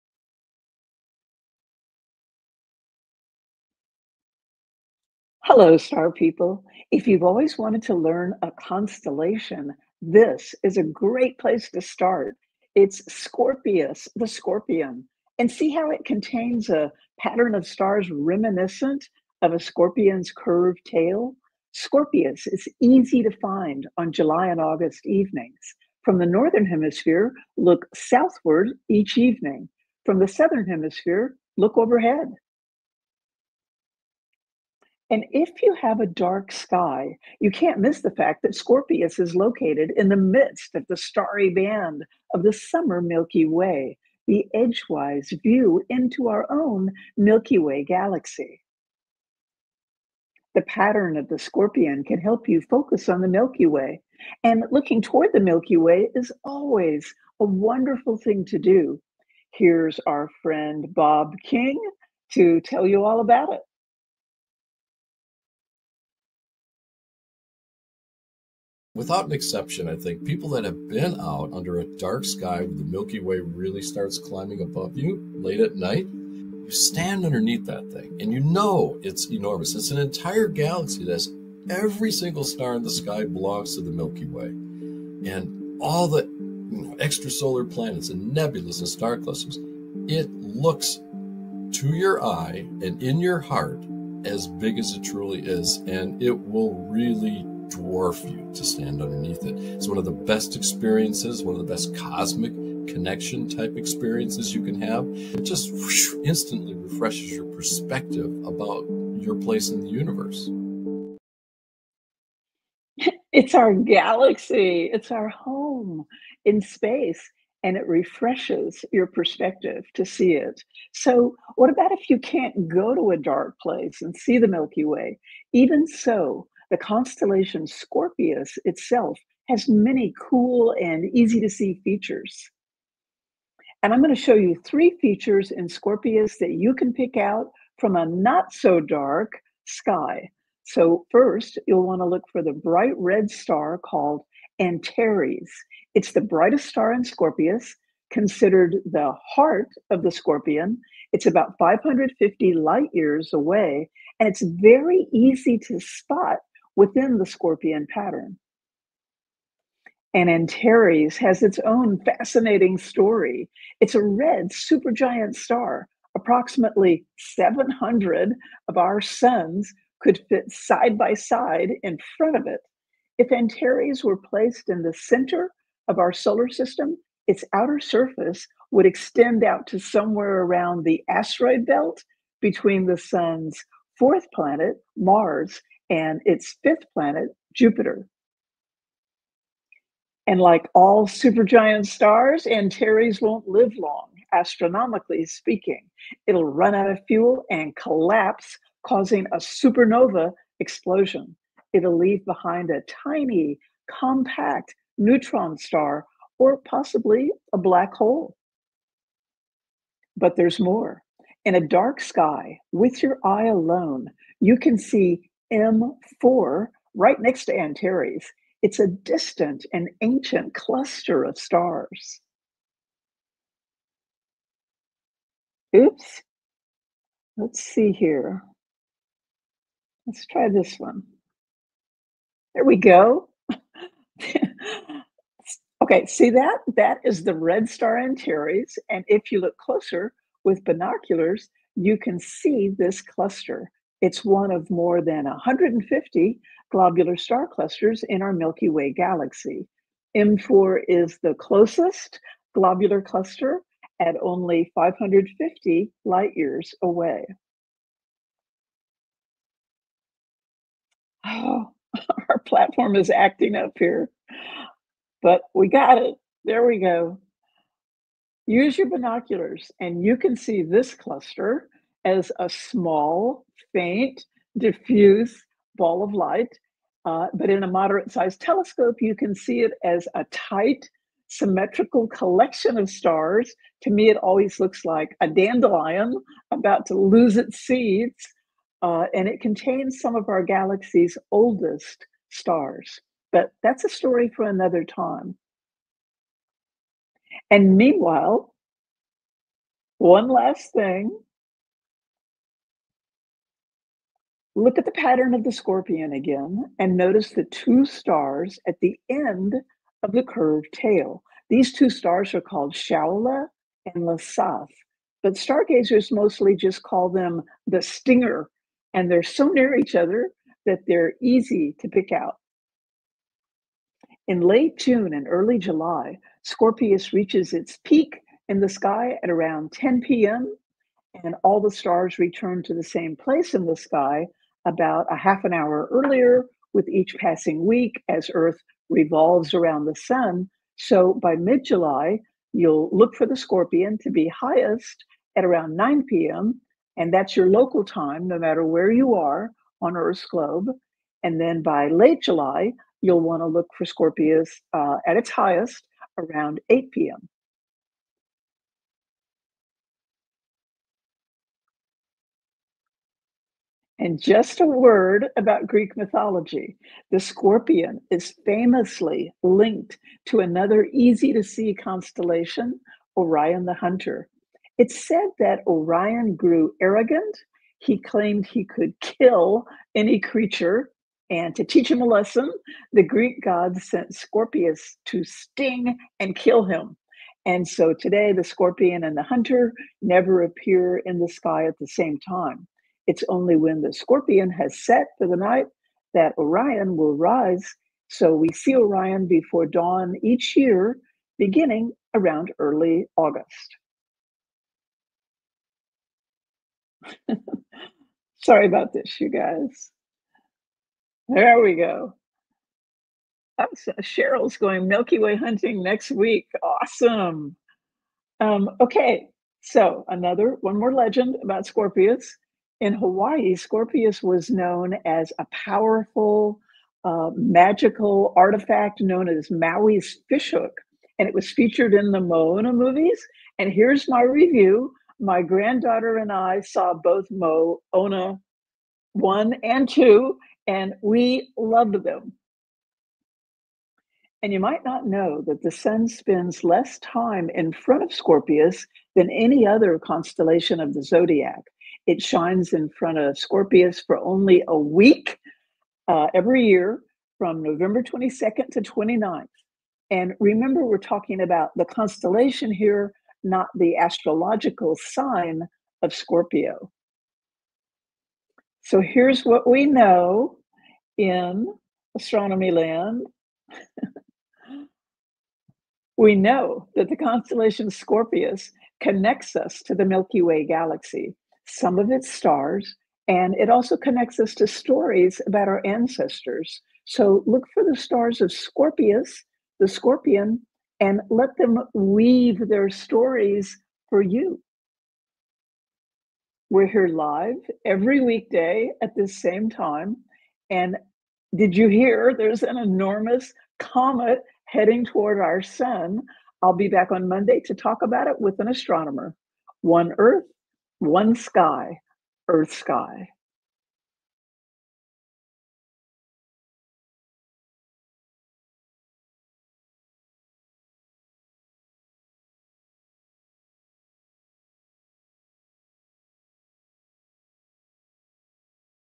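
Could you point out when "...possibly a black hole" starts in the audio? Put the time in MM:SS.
03:26.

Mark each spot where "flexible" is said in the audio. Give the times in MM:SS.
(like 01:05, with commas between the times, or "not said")
not said.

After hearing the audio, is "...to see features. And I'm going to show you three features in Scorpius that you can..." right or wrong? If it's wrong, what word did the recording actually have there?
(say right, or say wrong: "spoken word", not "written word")
right.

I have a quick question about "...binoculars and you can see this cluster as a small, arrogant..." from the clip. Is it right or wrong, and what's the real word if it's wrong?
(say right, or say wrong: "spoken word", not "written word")
wrong: "faint", not "arrogant".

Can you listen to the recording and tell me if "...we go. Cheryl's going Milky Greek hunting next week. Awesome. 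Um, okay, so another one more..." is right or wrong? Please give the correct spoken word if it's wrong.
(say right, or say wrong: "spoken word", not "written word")
wrong: "Way", not "Greek".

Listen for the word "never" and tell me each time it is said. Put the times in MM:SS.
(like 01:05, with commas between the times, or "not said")
06:30.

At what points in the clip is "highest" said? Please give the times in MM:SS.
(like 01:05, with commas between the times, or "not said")
05:44, 05:55.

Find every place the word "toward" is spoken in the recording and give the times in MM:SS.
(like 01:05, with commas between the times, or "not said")
00:55, 08:25.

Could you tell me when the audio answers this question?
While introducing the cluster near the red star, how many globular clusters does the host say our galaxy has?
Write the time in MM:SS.
04:04.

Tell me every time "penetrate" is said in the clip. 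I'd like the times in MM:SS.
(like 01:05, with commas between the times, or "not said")
not said.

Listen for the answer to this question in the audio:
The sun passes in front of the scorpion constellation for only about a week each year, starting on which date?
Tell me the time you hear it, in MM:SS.
07:37.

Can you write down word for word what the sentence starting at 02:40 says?
And Antares has its own fascinating story.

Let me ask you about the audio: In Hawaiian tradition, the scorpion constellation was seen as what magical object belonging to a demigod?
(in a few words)
Maui's fishhook.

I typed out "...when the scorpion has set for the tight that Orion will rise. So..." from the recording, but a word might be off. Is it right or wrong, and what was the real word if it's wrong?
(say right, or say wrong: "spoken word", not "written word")
wrong: "night", not "tight".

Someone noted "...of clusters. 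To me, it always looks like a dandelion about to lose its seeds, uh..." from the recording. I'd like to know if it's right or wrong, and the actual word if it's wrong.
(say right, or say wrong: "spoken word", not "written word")
wrong: "stars", not "clusters".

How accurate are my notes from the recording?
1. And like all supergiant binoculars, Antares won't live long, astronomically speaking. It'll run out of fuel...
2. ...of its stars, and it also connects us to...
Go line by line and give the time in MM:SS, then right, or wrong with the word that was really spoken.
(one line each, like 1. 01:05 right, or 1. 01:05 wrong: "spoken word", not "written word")
1. 03:10 wrong: "stars", not "binoculars"
2. 08:01 right.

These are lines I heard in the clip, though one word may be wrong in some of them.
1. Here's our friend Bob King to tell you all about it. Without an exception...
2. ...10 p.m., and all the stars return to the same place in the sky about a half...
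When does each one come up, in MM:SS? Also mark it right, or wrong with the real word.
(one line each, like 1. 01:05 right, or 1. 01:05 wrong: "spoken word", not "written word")
1. 00:59 right
2. 05:29 right.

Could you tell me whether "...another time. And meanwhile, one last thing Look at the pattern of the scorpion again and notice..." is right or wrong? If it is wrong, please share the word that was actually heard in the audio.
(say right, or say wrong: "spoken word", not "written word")
right.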